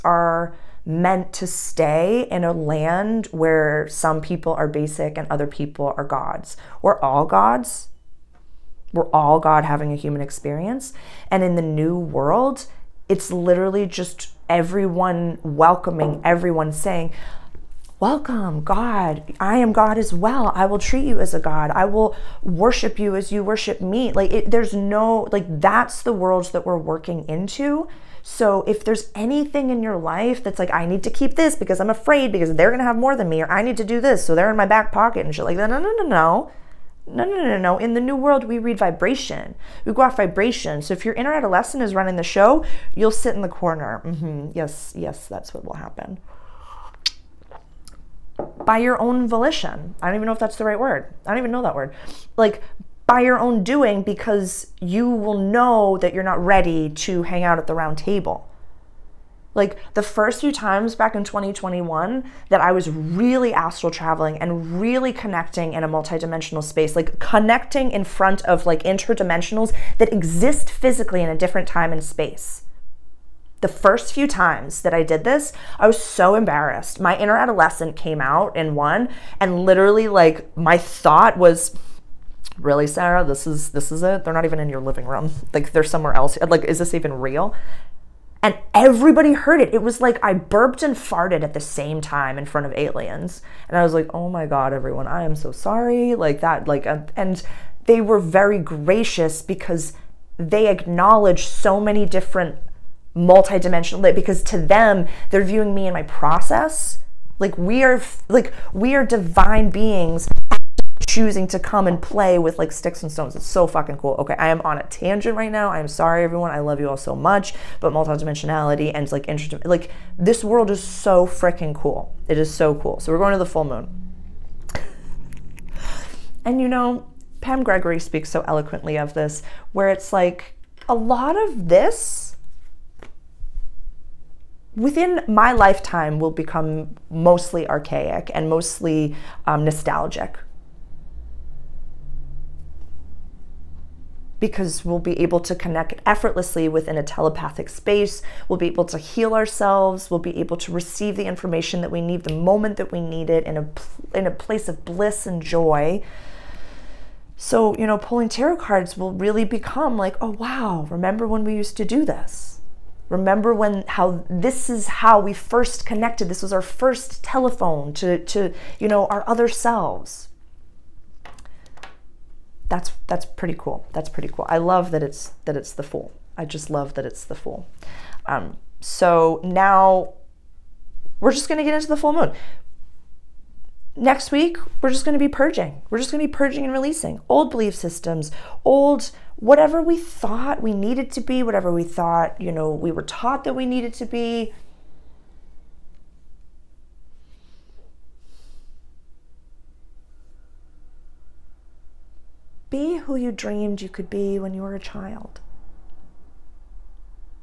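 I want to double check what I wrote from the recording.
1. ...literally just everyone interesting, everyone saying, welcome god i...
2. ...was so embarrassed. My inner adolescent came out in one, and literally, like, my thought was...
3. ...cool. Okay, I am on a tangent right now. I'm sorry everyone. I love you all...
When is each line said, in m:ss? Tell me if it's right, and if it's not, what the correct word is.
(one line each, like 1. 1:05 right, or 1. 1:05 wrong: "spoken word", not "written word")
1. 0:13 wrong: "welcoming", not "interesting"
2. 1:15 right
3. 1:53 right.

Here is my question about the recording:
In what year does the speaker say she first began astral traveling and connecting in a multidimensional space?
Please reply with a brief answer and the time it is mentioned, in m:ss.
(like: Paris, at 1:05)
2021, at 1:01.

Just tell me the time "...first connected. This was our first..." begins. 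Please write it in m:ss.
2:45.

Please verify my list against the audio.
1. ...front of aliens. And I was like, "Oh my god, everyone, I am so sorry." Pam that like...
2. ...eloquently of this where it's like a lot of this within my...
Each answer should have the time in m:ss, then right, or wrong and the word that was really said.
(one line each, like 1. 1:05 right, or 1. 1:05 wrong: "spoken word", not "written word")
1. 1:32 wrong: "Like", not "Pam"
2. 2:08 right.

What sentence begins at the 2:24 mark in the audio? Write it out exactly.
Because we'll be able to connect effortlessly within a telepathic space.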